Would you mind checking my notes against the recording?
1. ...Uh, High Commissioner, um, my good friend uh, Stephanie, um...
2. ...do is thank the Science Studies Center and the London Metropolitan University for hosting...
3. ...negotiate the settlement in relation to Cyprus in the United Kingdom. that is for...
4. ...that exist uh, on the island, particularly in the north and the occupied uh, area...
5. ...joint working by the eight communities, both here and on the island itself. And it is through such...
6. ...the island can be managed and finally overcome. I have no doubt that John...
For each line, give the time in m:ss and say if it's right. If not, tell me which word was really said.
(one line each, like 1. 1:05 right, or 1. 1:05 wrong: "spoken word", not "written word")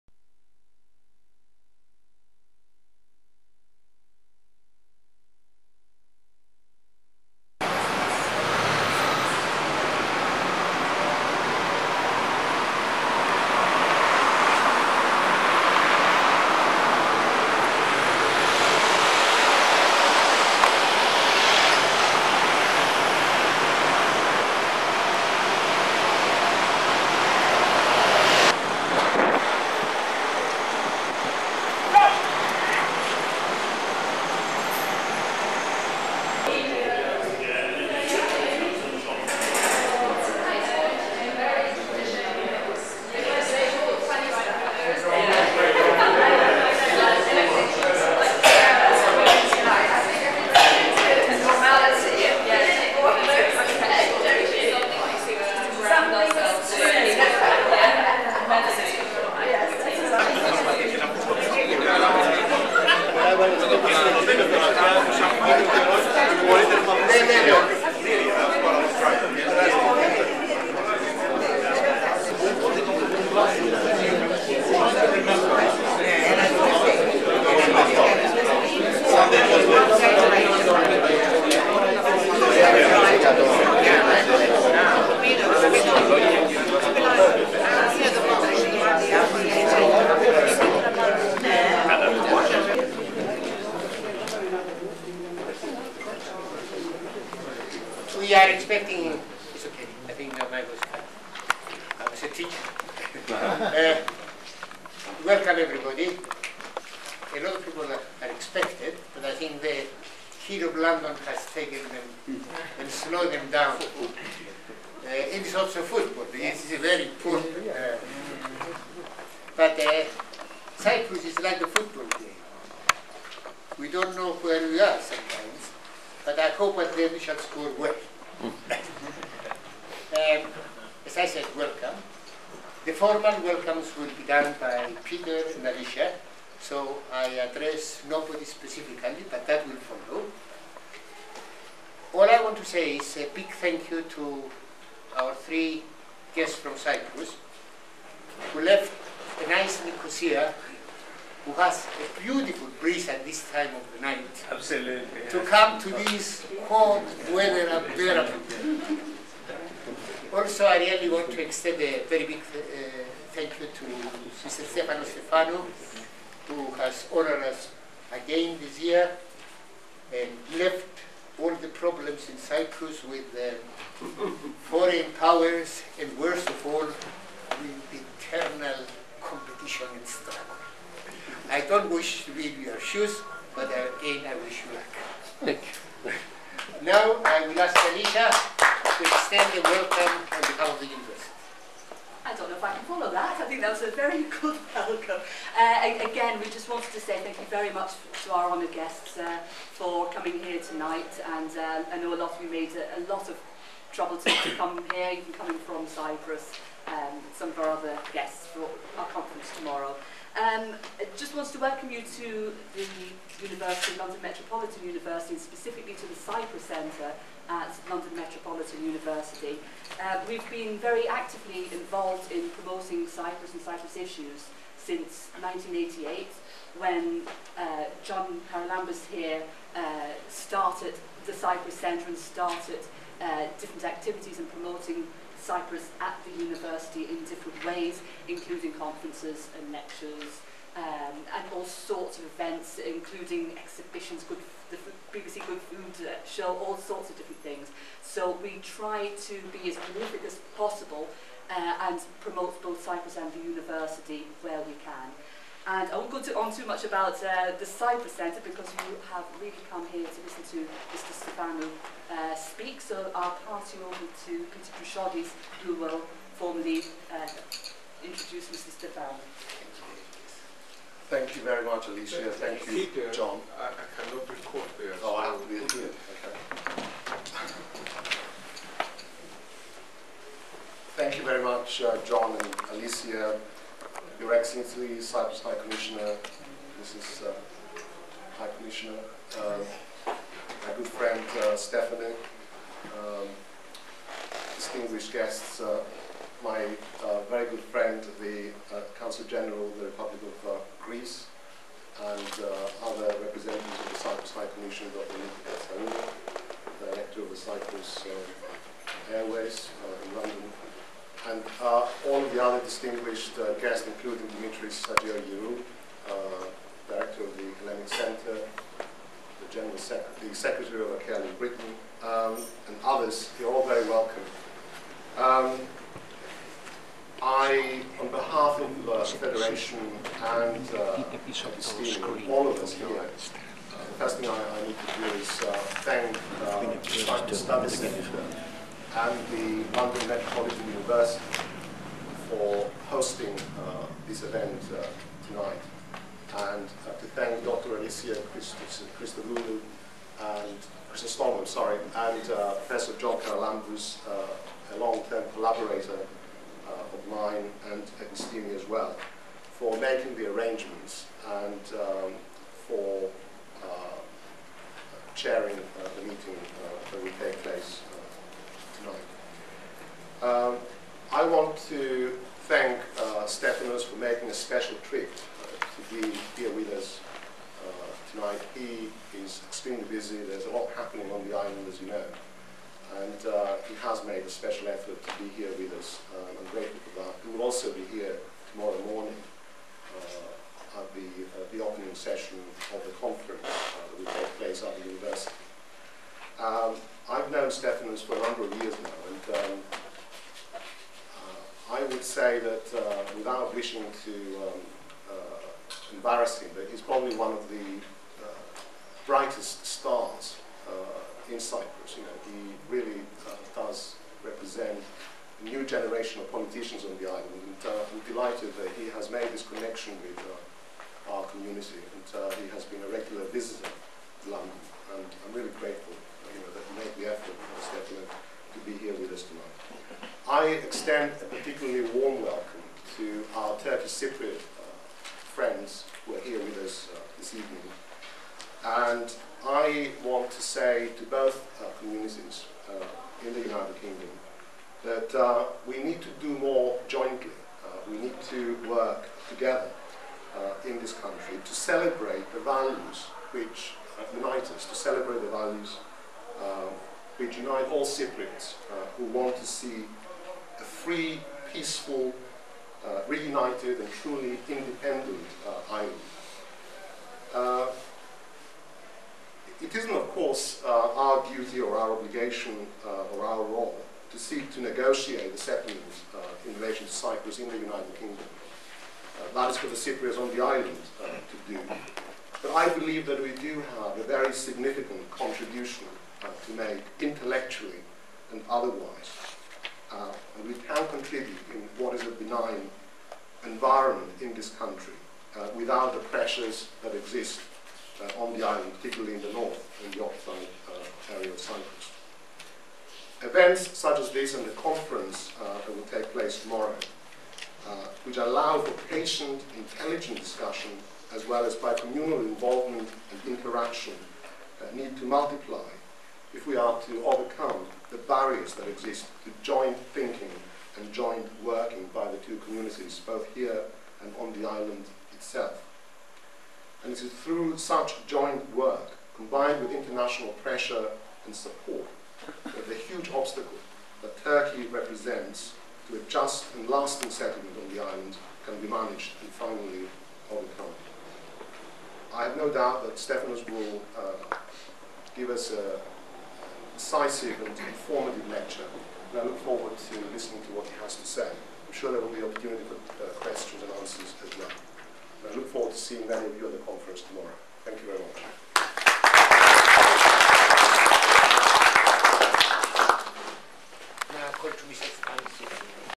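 1. 4:47 right
2. 5:34 right
3. 7:54 right
4. 8:16 right
5. 8:40 wrong: "two", not "eight"
6. 8:57 wrong: "Stephanos", not "John".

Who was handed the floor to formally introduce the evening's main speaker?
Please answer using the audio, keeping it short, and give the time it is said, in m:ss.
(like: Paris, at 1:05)
Peter Droussiotis, at 4:24.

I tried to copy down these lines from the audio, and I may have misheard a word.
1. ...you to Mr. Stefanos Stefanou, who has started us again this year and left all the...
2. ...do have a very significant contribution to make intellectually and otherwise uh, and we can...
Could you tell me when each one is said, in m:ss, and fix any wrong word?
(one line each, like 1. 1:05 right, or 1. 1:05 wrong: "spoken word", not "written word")
1. 2:43 wrong: "honored", not "started"
2. 8:03 right.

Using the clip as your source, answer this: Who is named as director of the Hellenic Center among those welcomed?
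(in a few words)
Dimitris Sagiou.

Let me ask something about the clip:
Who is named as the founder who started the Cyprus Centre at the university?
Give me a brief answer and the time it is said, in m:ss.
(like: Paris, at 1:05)
John Paralambas, at 3:48.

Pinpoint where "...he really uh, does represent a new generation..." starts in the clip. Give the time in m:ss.
6:52.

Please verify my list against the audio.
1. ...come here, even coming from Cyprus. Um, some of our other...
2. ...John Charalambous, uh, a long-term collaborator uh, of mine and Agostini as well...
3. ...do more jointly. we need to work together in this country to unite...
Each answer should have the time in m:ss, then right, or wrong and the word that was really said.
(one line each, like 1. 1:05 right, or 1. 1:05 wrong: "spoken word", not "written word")
1. 3:24 right
2. 5:52 right
3. 7:26 wrong: "celebrate", not "unite".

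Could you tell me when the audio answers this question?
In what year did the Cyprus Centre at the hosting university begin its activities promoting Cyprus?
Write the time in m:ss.
3:45.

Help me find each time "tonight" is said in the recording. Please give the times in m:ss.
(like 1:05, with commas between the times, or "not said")
3:20, 5:45, 6:18, 7:09.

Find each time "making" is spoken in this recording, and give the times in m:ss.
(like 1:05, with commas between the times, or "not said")
5:59, 6:13.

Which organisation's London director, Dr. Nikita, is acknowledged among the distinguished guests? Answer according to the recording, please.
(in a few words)
Cyprus Airways.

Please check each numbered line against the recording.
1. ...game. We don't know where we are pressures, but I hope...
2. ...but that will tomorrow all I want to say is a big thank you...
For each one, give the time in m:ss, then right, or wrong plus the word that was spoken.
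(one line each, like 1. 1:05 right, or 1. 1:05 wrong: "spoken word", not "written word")
1. 2:02 wrong: "sometimes", not "pressures"
2. 2:19 wrong: "follow", not "tomorrow".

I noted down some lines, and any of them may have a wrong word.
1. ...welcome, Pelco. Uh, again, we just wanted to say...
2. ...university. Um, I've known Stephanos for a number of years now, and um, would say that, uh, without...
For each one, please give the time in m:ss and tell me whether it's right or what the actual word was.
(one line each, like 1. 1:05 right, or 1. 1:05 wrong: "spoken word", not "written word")
1. 3:14 right
2. 6:34 right.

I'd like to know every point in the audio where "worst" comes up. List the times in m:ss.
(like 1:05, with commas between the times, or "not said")
2:56.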